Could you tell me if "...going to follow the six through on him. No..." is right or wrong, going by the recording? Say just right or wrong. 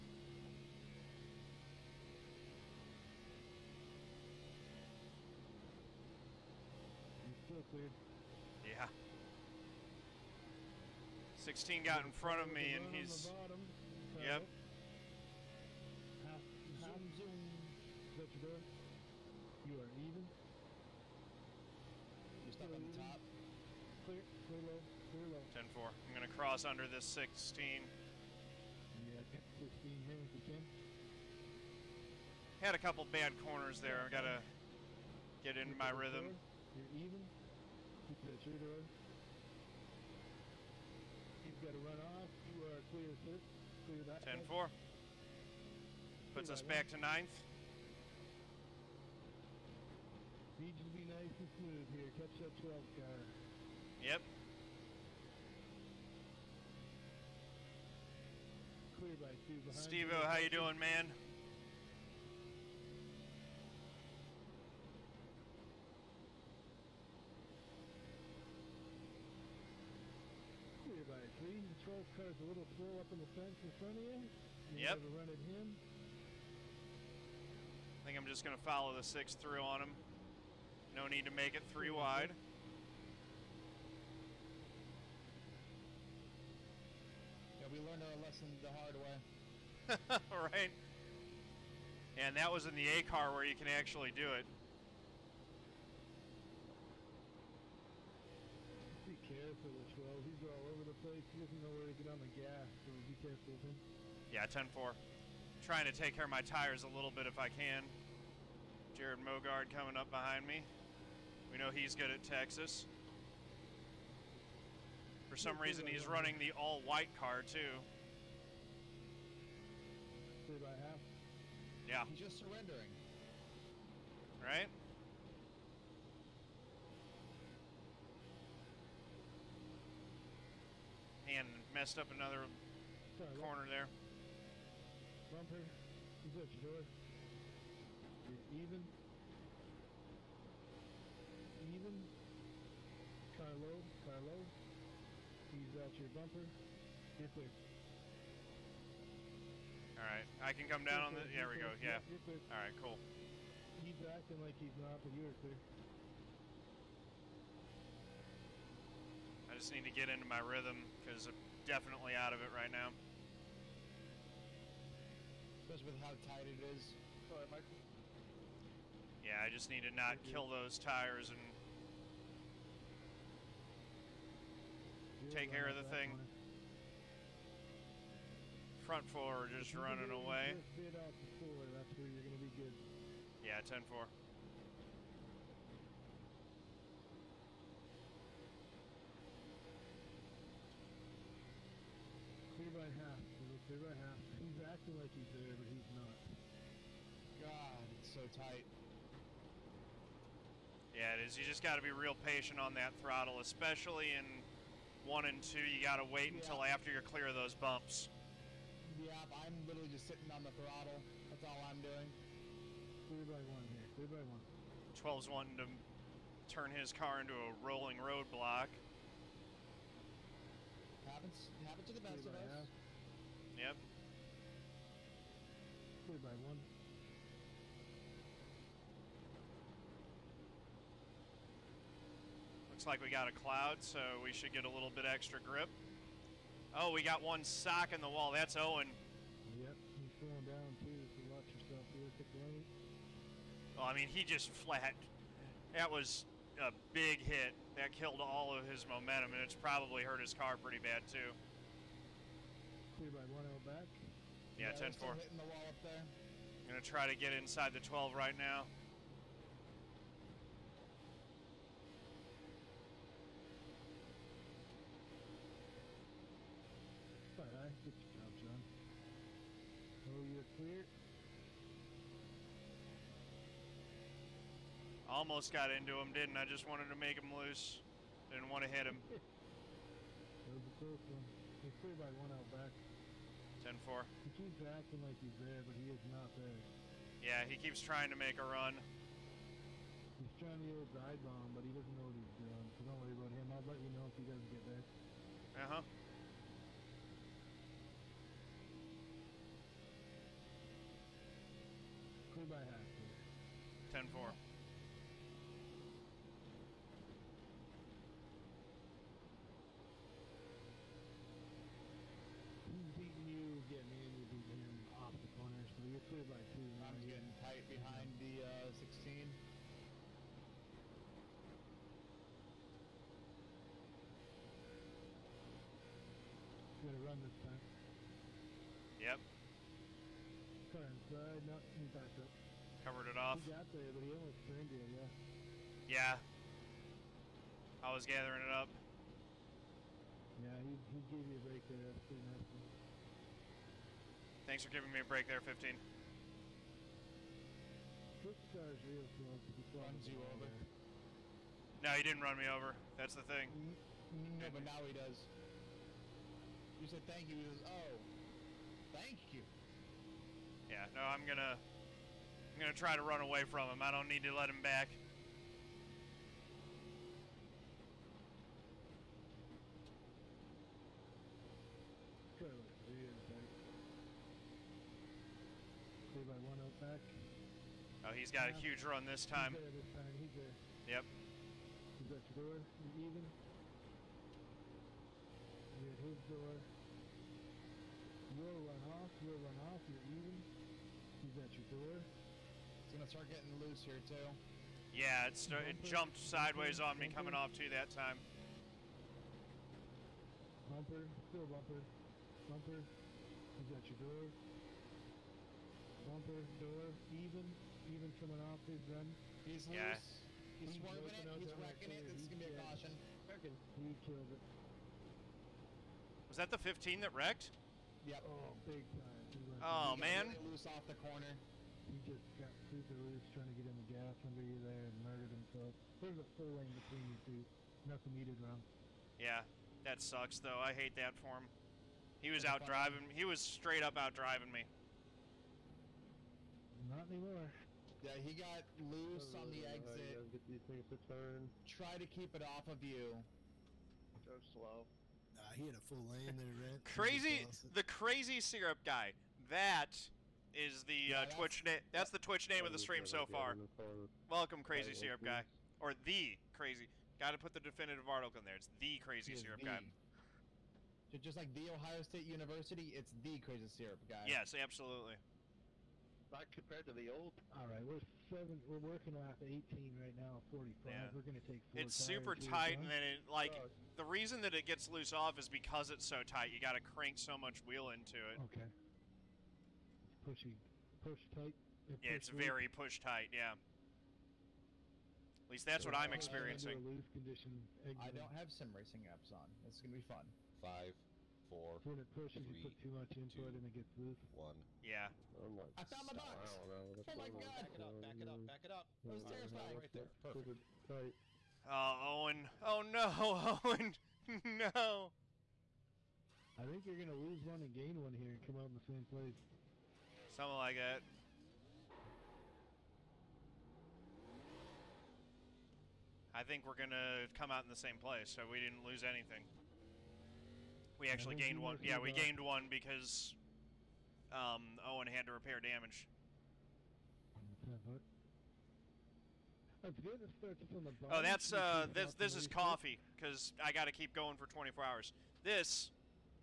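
right.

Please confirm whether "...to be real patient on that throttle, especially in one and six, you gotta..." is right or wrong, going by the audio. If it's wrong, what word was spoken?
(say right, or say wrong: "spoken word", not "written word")
wrong: "two", not "six".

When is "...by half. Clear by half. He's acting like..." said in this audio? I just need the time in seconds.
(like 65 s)
192 s.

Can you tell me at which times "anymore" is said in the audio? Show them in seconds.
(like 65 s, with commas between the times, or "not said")
437 s.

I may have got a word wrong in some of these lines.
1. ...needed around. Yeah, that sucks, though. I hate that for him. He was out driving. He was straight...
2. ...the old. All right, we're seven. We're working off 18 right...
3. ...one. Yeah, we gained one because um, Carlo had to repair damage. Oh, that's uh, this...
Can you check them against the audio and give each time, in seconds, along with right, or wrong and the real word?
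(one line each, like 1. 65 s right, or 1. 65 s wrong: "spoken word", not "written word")
1. 428 s right
2. 466 s right
3. 521 s wrong: "Owen", not "Carlo".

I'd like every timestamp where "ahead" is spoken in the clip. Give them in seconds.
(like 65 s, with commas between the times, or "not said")
167 s.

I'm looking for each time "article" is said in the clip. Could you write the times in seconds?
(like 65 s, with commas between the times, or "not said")
458 s.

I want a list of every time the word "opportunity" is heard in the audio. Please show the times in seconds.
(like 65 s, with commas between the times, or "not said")
not said.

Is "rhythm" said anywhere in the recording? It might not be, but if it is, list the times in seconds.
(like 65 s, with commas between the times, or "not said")
35 s, 160 s.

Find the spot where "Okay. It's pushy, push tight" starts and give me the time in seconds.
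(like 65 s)
478 s.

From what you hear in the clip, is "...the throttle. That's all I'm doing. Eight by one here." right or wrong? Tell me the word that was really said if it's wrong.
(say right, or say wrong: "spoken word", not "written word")
wrong: "Three", not "Eight".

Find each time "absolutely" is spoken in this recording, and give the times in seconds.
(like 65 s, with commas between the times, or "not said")
464 s.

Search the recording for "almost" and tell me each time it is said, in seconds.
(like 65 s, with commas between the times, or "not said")
275 s, 334 s.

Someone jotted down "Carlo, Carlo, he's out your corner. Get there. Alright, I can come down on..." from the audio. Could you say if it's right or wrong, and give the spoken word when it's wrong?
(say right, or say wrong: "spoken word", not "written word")
wrong: "bumper", not "corner".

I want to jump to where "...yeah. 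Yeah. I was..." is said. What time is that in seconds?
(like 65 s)
334 s.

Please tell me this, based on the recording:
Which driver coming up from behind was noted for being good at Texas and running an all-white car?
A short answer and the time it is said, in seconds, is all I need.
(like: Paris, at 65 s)
Jared Mogard, at 108 s.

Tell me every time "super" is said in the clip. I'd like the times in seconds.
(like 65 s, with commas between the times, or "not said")
422 s, 471 s.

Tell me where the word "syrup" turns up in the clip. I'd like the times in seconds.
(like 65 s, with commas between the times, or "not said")
448 s, 454 s, 459 s, 463 s.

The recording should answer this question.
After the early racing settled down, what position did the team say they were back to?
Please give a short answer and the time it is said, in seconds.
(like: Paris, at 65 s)
ninth, at 46 s.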